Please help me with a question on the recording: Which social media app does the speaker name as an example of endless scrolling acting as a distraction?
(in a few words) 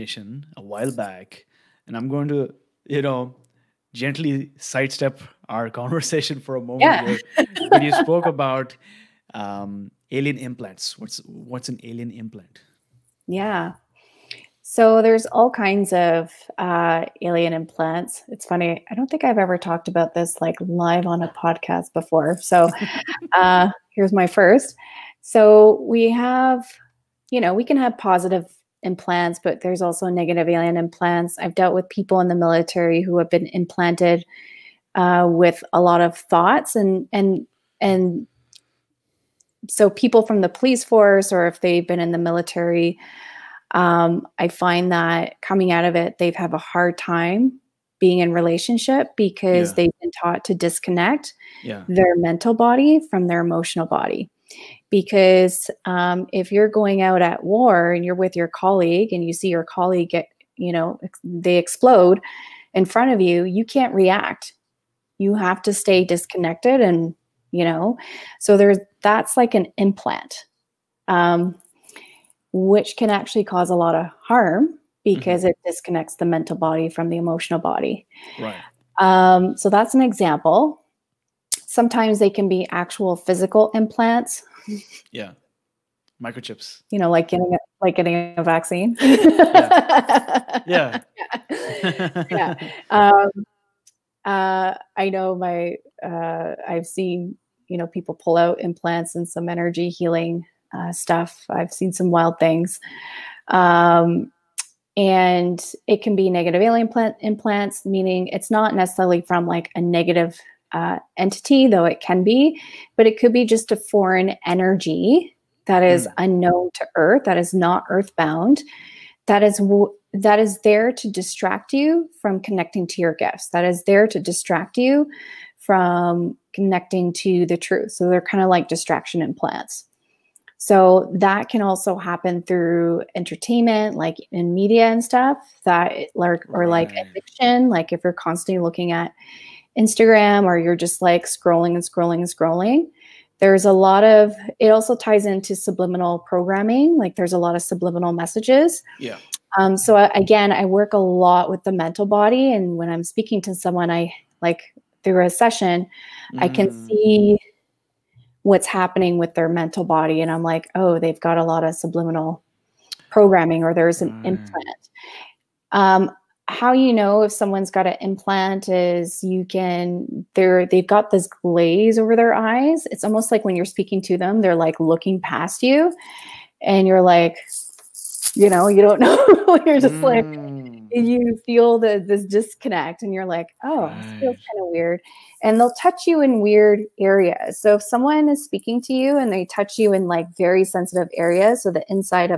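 Instagram.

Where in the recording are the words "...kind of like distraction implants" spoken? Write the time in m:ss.
2:08.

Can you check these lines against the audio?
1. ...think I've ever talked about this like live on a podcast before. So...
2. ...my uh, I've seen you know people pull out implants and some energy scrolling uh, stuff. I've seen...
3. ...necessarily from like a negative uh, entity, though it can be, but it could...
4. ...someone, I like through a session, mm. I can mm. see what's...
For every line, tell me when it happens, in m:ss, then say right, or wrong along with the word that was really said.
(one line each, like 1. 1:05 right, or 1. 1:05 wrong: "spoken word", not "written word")
1. 0:19 right
2. 1:35 wrong: "healing", not "scrolling"
3. 1:48 right
4. 2:33 right.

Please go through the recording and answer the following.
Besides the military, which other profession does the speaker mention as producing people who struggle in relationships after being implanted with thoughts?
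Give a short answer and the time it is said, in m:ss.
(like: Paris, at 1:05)
police force, at 0:40.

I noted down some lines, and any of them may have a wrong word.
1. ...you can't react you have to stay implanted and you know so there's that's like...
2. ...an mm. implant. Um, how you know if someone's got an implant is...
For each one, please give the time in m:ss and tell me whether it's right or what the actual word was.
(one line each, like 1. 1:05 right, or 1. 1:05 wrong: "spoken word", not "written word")
1. 1:03 wrong: "disconnected", not "implanted"
2. 2:44 right.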